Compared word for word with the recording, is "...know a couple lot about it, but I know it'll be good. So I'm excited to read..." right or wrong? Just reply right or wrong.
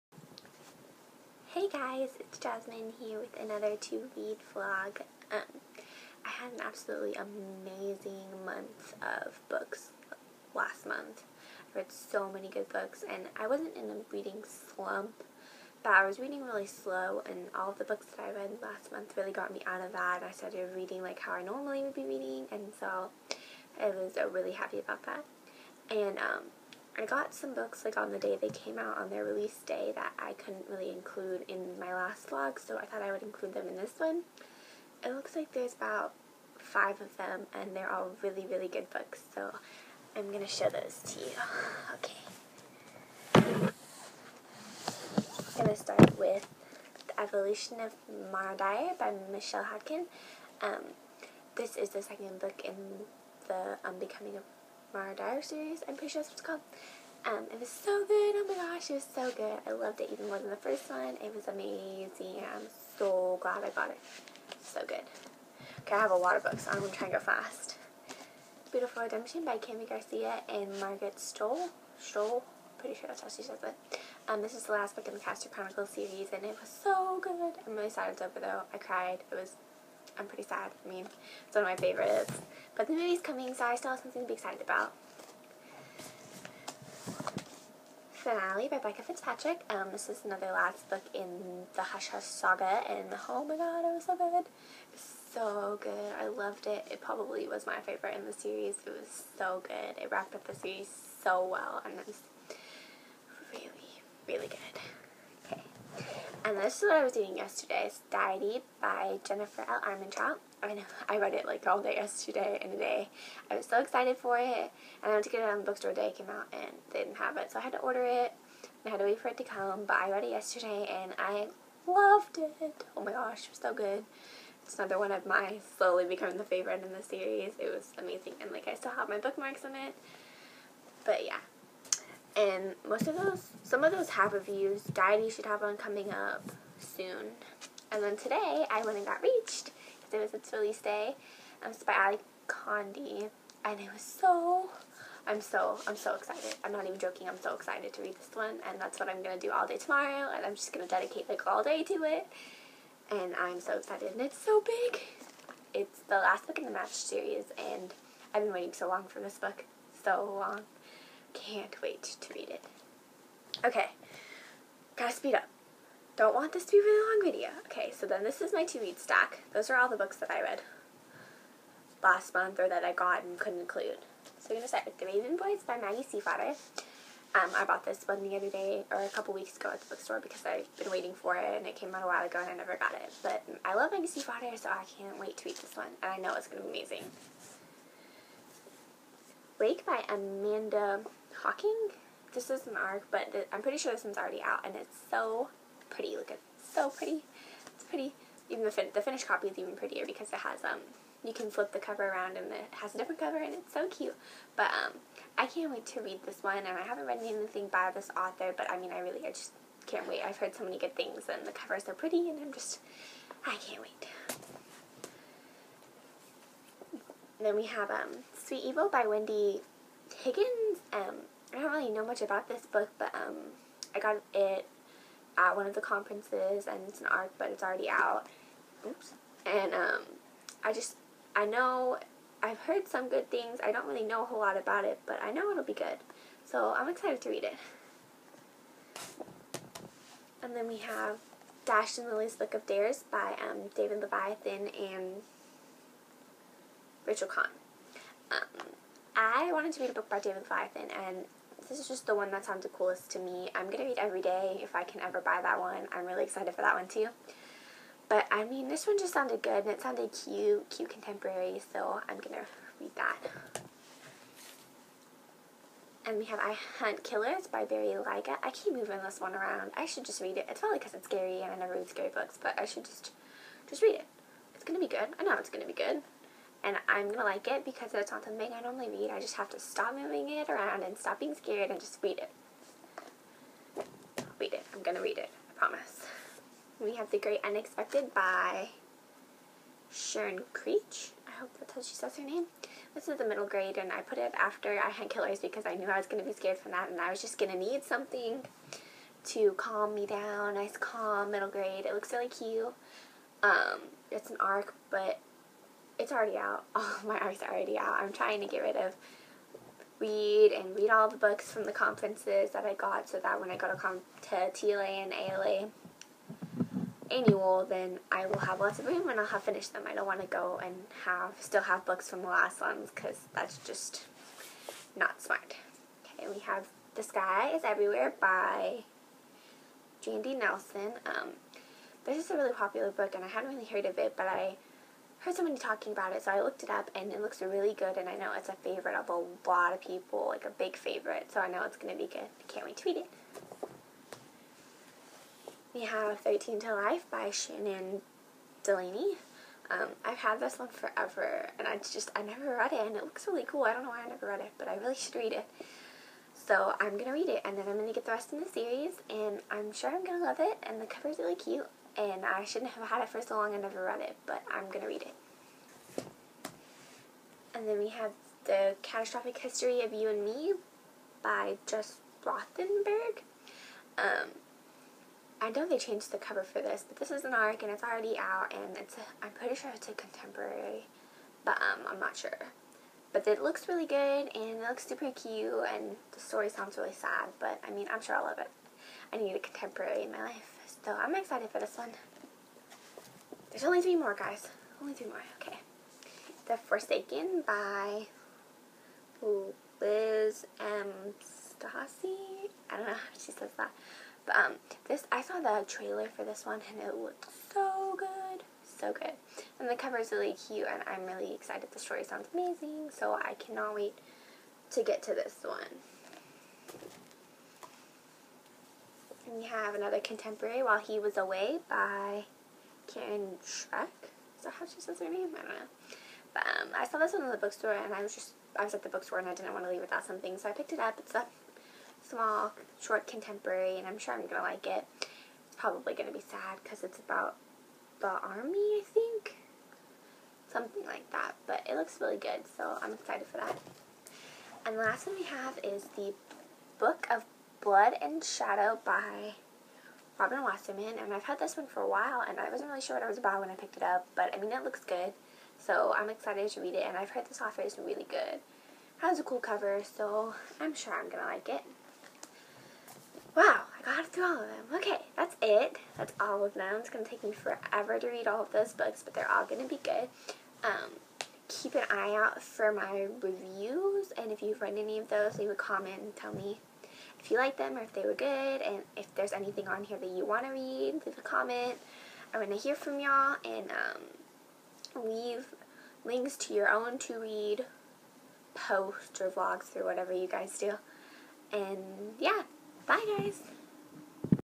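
wrong.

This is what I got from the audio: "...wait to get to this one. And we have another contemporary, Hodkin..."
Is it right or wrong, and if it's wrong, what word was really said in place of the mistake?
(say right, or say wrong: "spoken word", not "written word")
wrong: "While", not "Hodkin".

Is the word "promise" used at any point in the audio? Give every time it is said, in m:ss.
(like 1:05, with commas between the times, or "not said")
4:45.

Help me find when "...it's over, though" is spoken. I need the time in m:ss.
1:18.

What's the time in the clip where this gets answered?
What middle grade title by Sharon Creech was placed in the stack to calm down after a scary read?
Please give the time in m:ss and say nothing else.
4:47.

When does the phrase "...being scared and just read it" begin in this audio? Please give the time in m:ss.
4:41.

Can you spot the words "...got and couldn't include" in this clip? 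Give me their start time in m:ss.
2:52.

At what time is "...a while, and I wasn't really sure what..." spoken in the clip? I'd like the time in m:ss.
7:31.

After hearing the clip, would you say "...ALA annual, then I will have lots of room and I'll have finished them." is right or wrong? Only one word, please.
right.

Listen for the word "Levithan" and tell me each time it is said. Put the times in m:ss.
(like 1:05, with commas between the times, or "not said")
4:03, 4:10.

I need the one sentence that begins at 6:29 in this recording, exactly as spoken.
I need a contemporary in my life.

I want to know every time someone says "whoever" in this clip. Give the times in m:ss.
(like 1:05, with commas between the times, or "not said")
not said.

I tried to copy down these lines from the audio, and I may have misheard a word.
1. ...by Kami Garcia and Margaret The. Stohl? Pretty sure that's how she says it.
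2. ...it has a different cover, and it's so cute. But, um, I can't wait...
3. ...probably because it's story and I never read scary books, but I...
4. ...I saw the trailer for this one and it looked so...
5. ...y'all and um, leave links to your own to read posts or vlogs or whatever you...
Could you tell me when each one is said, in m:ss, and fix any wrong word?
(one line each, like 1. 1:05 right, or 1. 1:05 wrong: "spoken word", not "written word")
1. 1:09 wrong: "Stohl", not "The"
2. 3:22 right
3. 4:30 wrong: "scary", not "story"
4. 6:45 right
5. 8:02 right.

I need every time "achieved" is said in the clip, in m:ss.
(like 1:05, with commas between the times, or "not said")
not said.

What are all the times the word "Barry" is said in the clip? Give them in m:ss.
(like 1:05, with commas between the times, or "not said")
4:27.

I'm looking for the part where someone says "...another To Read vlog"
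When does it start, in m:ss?
0:03.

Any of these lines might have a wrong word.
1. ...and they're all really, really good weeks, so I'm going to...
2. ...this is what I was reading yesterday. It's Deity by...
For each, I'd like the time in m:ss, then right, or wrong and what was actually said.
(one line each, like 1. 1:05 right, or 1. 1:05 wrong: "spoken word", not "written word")
1. 0:37 wrong: "books", not "weeks"
2. 1:46 wrong: "eating", not "reading".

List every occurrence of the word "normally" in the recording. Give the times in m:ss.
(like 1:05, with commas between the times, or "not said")
0:21, 4:38.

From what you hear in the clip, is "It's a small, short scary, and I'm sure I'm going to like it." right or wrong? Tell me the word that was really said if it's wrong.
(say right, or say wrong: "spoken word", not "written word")
wrong: "contemporary", not "scary".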